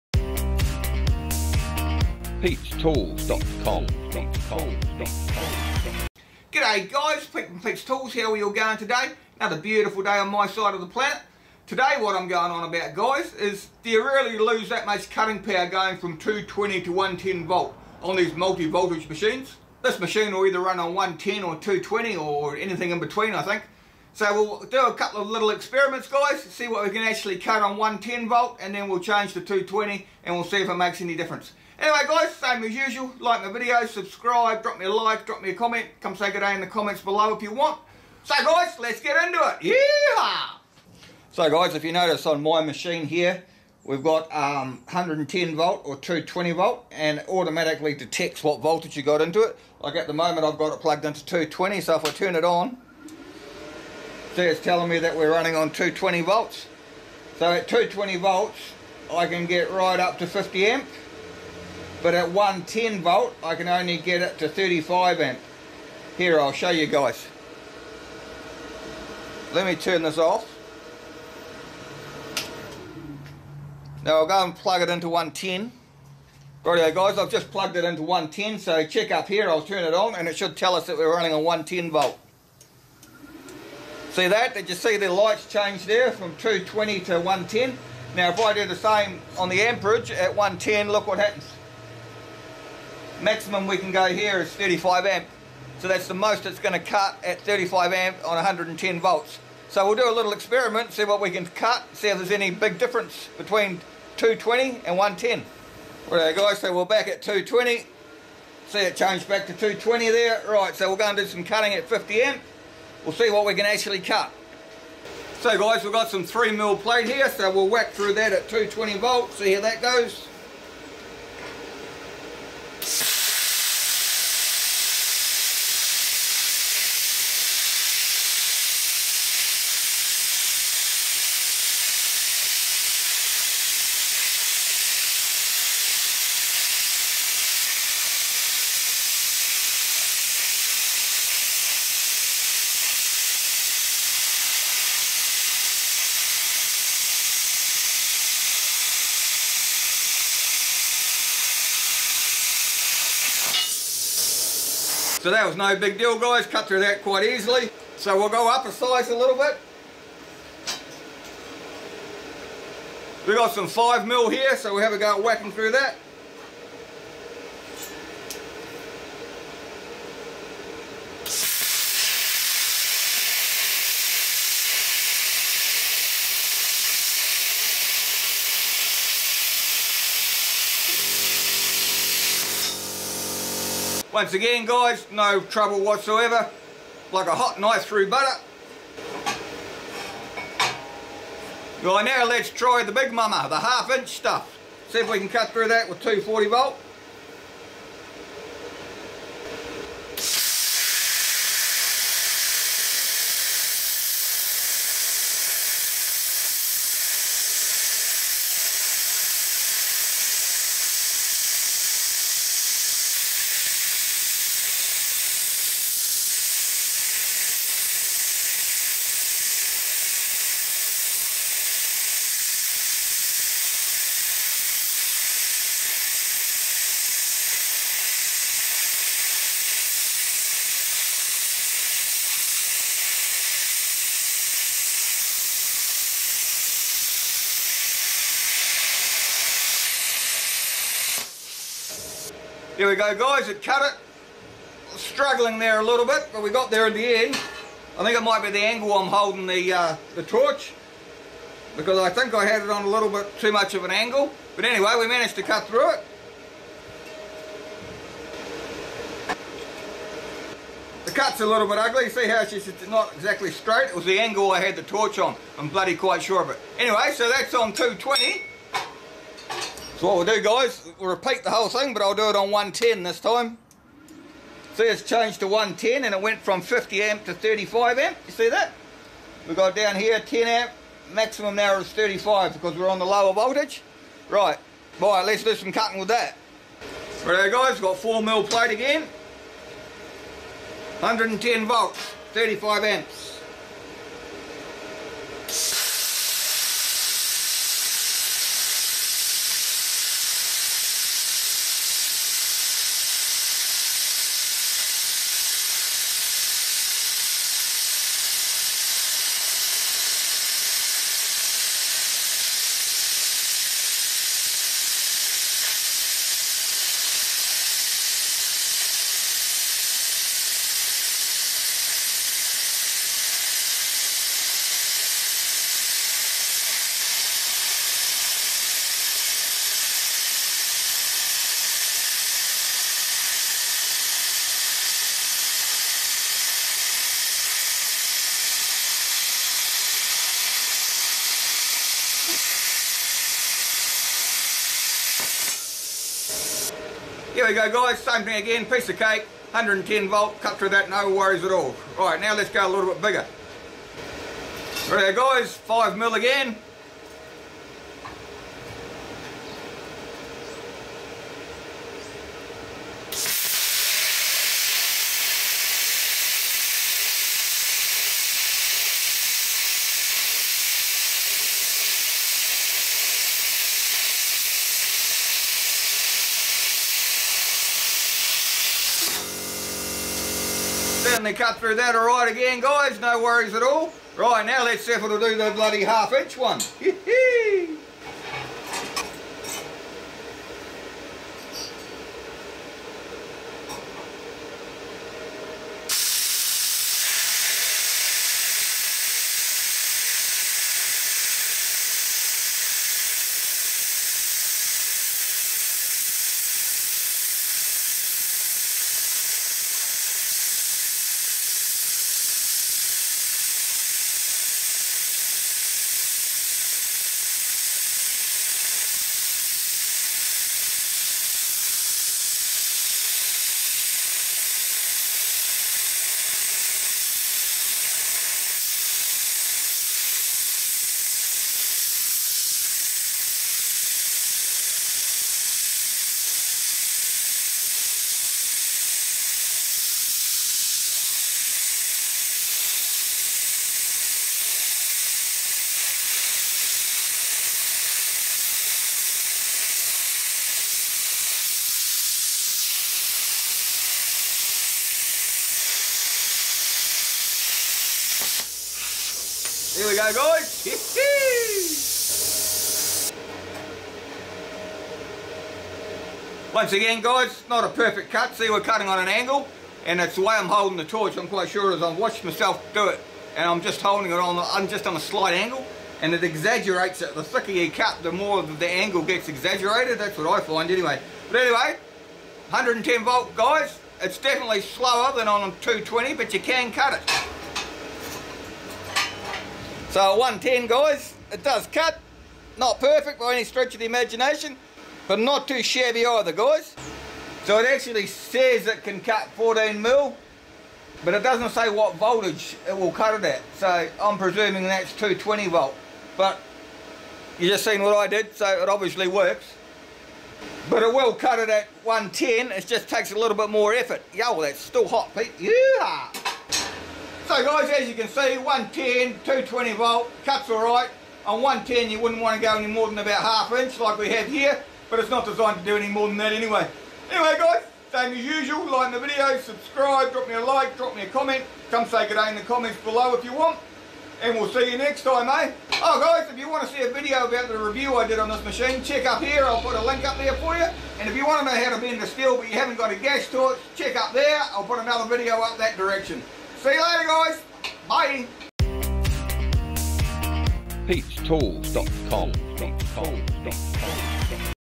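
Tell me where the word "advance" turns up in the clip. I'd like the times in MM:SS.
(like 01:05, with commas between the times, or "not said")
not said.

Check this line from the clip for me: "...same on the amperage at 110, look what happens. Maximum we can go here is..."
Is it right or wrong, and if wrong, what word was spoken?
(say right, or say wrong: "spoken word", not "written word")
right.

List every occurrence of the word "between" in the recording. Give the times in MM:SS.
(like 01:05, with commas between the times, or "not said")
00:22, 01:43.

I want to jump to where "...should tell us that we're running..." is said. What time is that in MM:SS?
01:20.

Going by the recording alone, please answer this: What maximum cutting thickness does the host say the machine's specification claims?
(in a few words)
14 mil.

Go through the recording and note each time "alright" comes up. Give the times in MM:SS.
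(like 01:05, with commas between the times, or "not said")
08:40.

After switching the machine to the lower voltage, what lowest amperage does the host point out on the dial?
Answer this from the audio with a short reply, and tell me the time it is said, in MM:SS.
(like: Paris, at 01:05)
10 amp, at 04:40.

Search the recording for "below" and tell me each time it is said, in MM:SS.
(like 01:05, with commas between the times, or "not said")
00:37, 08:52.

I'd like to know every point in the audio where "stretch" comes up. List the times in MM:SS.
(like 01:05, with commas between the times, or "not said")
08:13.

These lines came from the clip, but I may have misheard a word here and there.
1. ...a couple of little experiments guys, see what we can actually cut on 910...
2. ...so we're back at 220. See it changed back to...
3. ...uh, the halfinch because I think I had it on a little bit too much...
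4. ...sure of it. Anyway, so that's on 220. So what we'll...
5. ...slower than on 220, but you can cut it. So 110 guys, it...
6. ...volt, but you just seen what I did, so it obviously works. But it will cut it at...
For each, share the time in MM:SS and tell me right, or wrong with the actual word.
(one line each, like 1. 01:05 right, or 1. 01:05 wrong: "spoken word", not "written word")
1. 00:24 wrong: "110", not "910"
2. 01:46 right
3. 04:09 wrong: "torch", not "halfinch"
4. 04:26 right
5. 08:04 right
6. 08:25 right.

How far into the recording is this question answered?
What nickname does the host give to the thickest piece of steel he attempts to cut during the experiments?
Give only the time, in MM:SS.
03:12.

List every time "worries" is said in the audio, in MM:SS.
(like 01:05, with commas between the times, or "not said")
05:51, 06:23.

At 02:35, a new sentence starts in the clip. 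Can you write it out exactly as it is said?
So that was no big deal guys, cut through that quite easily.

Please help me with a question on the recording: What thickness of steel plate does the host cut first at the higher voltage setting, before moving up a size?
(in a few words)
3 mil.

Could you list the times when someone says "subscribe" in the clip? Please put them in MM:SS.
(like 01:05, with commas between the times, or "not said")
00:33, 08:49.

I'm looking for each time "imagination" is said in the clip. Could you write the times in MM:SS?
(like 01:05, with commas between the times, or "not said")
08:13.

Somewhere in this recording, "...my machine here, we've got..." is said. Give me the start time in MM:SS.
00:42.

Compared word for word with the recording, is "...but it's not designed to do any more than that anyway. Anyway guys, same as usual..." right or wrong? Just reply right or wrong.
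right.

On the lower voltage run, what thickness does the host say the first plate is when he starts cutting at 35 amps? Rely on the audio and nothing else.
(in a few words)
4 mil.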